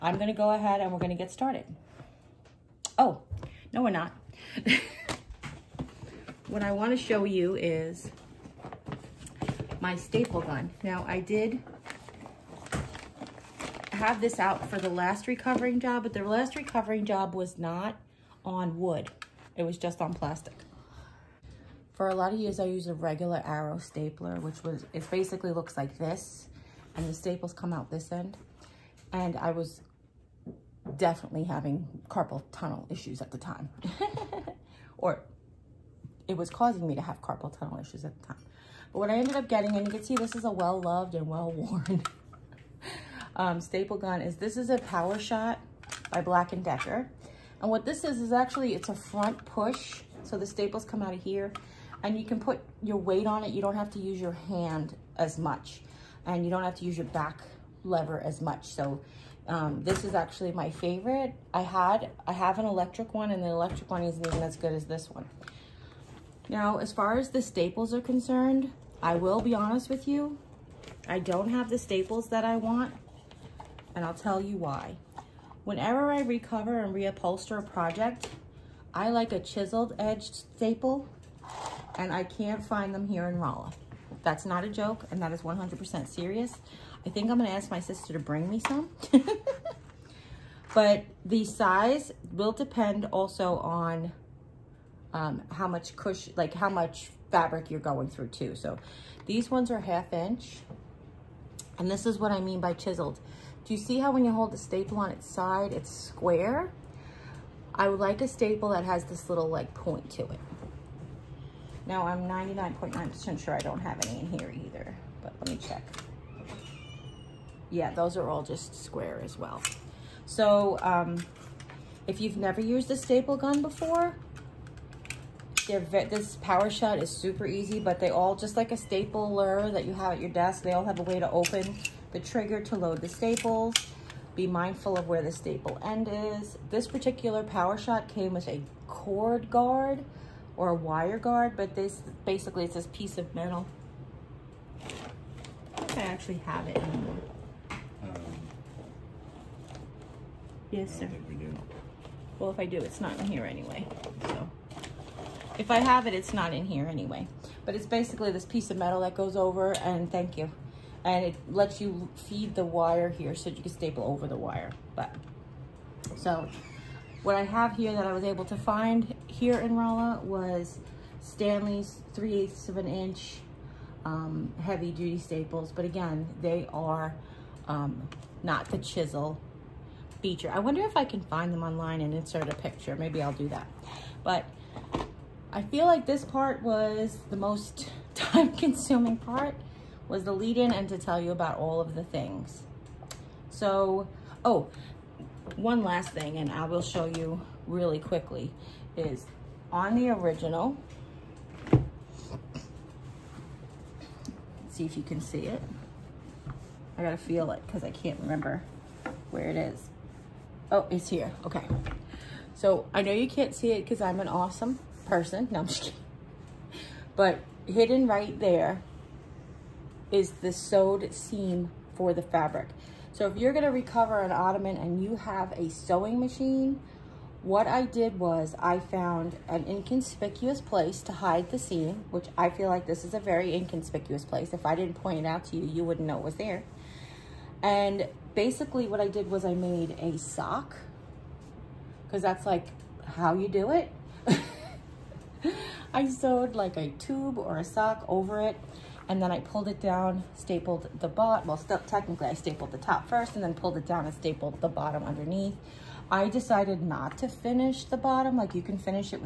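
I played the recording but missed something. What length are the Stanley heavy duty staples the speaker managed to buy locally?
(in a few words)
3/8 inch.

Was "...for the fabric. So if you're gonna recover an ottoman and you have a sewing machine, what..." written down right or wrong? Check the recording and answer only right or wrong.
right.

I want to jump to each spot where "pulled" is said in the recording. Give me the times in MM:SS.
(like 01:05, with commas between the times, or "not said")
04:09, 04:13.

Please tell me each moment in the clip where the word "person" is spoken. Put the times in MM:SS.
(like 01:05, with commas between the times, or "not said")
03:35.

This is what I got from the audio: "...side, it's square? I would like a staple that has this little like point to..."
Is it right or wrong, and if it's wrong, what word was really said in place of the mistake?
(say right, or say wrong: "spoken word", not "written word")
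right.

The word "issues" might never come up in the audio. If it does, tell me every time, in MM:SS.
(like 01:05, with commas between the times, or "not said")
00:32, 00:37.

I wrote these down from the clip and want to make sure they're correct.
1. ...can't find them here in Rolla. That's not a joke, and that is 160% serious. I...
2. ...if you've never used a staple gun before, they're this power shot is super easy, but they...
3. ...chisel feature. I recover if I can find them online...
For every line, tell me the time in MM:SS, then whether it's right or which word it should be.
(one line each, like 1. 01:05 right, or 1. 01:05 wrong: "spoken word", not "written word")
1. 01:22 wrong: "100", not "160"
2. 02:02 right
3. 02:58 wrong: "wonder", not "recover".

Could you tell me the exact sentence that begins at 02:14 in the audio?
Be mindful of where the staple end is.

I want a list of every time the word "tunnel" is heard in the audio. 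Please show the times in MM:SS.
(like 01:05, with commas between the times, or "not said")
00:32, 00:37.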